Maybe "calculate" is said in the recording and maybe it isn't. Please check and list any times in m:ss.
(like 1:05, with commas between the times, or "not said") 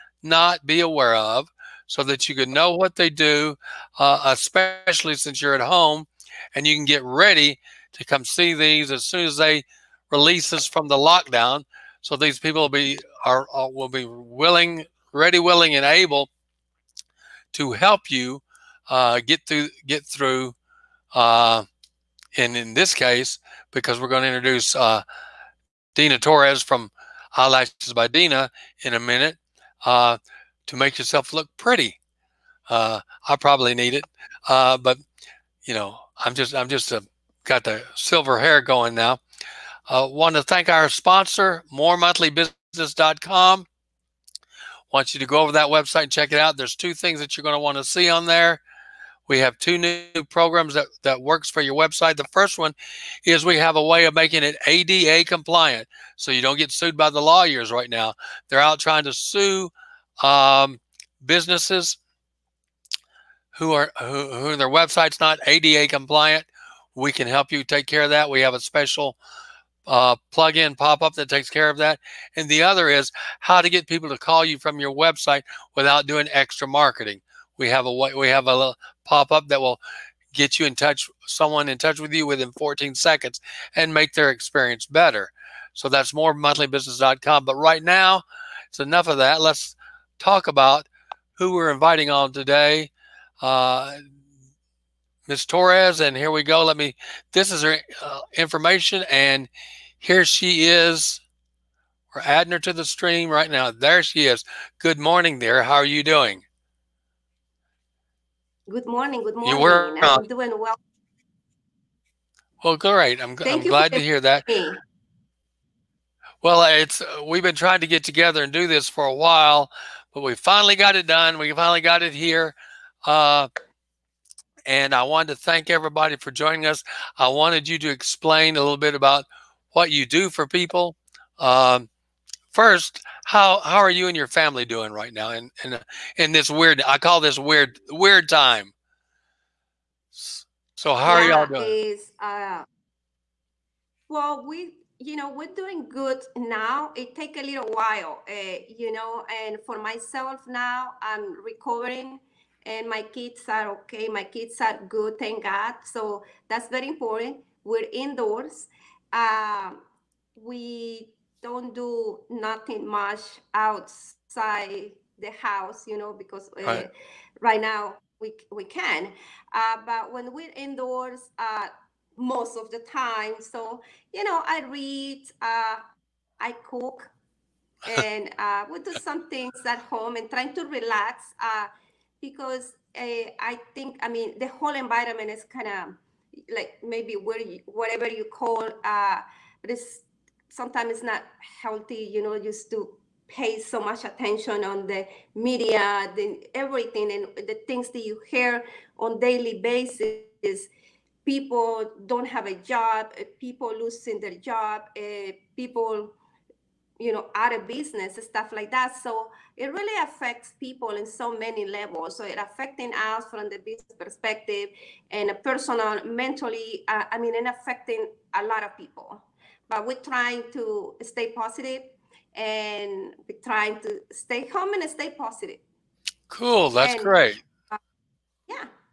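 not said.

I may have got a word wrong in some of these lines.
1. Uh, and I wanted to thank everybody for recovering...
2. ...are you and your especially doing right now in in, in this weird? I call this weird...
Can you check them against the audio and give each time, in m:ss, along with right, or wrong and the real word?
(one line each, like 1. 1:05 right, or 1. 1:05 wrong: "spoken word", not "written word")
1. 2:03 wrong: "joining", not "recovering"
2. 2:13 wrong: "family", not "especially".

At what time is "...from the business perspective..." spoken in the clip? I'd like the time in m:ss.
3:33.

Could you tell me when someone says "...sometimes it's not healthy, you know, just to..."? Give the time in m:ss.
3:10.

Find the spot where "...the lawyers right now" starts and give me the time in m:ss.
0:57.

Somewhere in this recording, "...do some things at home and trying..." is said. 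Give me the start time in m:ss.
2:58.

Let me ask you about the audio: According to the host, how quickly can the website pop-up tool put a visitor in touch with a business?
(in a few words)
14 seconds.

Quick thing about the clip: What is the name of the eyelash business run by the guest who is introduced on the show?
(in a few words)
Eyelashes by Dina.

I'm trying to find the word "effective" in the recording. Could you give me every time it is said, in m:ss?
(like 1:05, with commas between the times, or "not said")
not said.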